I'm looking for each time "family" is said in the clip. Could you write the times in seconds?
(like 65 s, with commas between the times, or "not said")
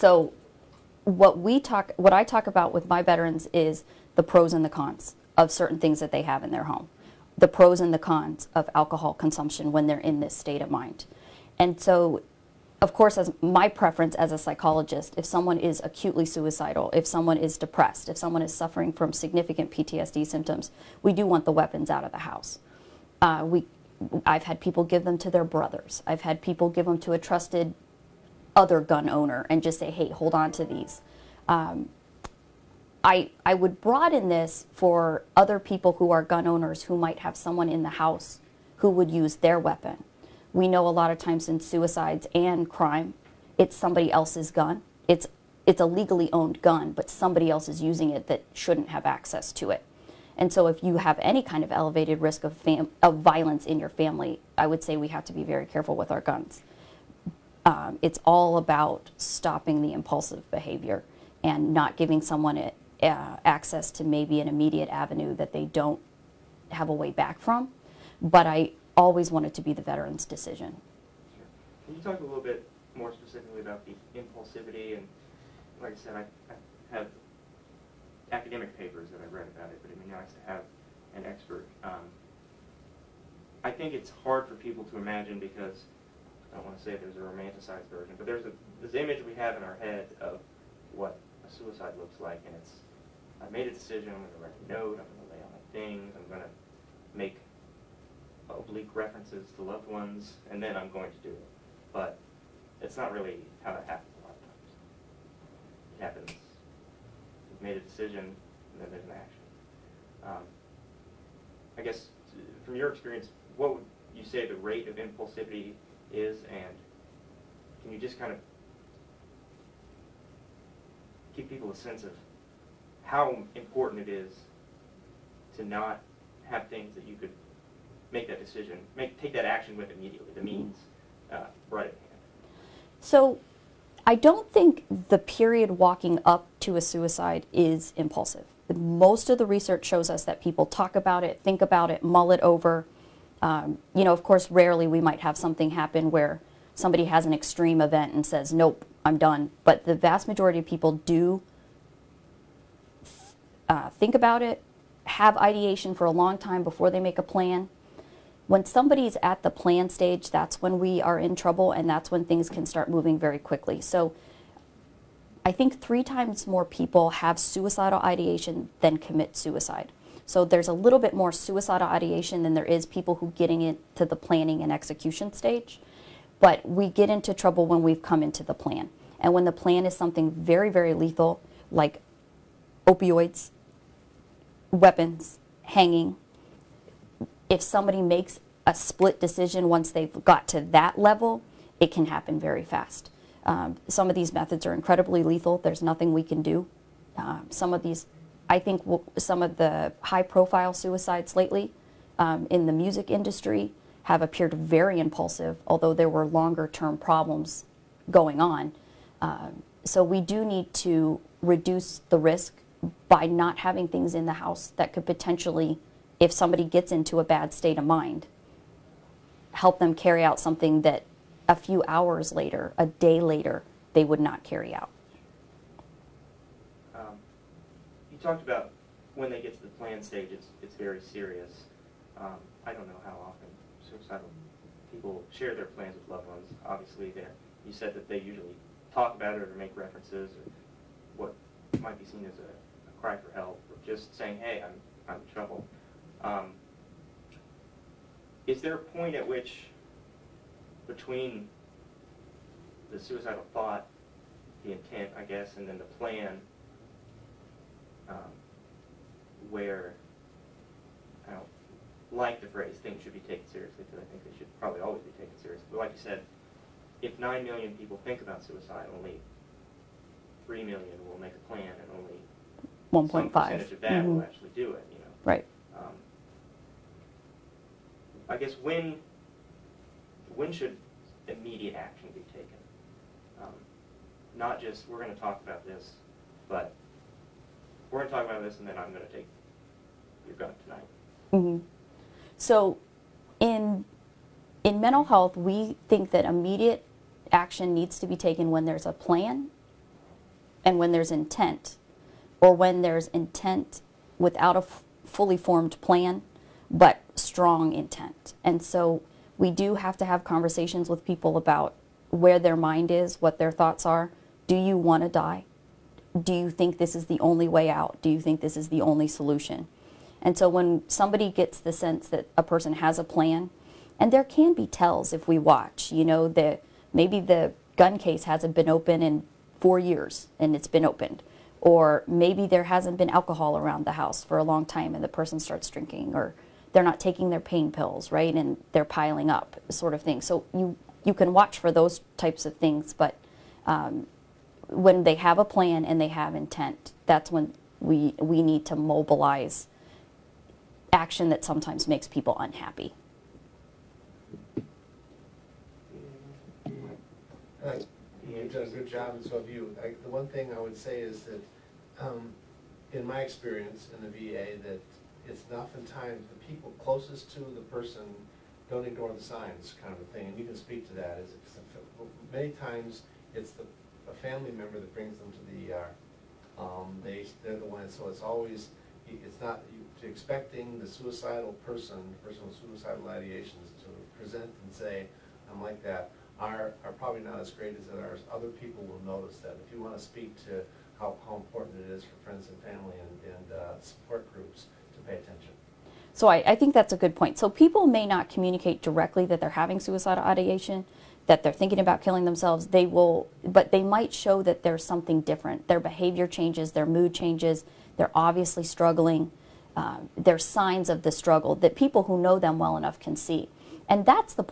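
53 s, 374 s, 392 s.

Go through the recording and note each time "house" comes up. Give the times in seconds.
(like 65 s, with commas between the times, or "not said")
22 s, 37 s, 214 s, 333 s.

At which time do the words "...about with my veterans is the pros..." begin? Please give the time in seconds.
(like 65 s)
2 s.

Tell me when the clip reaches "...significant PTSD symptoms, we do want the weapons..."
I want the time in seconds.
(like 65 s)
19 s.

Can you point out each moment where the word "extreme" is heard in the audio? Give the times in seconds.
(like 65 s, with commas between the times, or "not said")
147 s.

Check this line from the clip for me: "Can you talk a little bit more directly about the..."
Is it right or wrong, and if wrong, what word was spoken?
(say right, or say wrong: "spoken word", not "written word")
wrong: "specifically", not "directly".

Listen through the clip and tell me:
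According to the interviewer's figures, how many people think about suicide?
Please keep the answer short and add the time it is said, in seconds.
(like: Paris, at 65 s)
9 million, at 267 s.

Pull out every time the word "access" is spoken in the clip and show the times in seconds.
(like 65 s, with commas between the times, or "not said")
49 s, 63 s.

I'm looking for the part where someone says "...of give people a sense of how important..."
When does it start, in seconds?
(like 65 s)
118 s.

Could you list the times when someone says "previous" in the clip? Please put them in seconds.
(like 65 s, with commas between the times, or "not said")
not said.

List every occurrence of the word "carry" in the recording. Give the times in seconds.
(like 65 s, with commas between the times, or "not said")
219 s, 224 s.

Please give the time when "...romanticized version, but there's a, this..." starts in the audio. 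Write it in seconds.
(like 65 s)
87 s.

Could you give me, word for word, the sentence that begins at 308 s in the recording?
And so we do have to have conversations with people about where their mind is, what their thoughts are.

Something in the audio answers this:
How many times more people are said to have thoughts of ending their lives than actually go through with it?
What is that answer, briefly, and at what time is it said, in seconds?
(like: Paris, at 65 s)
3 times, at 165 s.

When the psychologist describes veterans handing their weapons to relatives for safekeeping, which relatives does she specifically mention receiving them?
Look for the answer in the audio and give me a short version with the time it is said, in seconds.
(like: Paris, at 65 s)
brothers, at 25 s.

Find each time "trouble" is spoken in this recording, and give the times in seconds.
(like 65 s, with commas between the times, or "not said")
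161 s, 177 s, 245 s.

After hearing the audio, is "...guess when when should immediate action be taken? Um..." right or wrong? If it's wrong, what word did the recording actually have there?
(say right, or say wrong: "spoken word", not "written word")
right.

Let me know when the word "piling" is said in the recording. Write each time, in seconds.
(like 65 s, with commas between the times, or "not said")
338 s.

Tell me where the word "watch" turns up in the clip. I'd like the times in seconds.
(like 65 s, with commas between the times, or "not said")
325 s, 341 s.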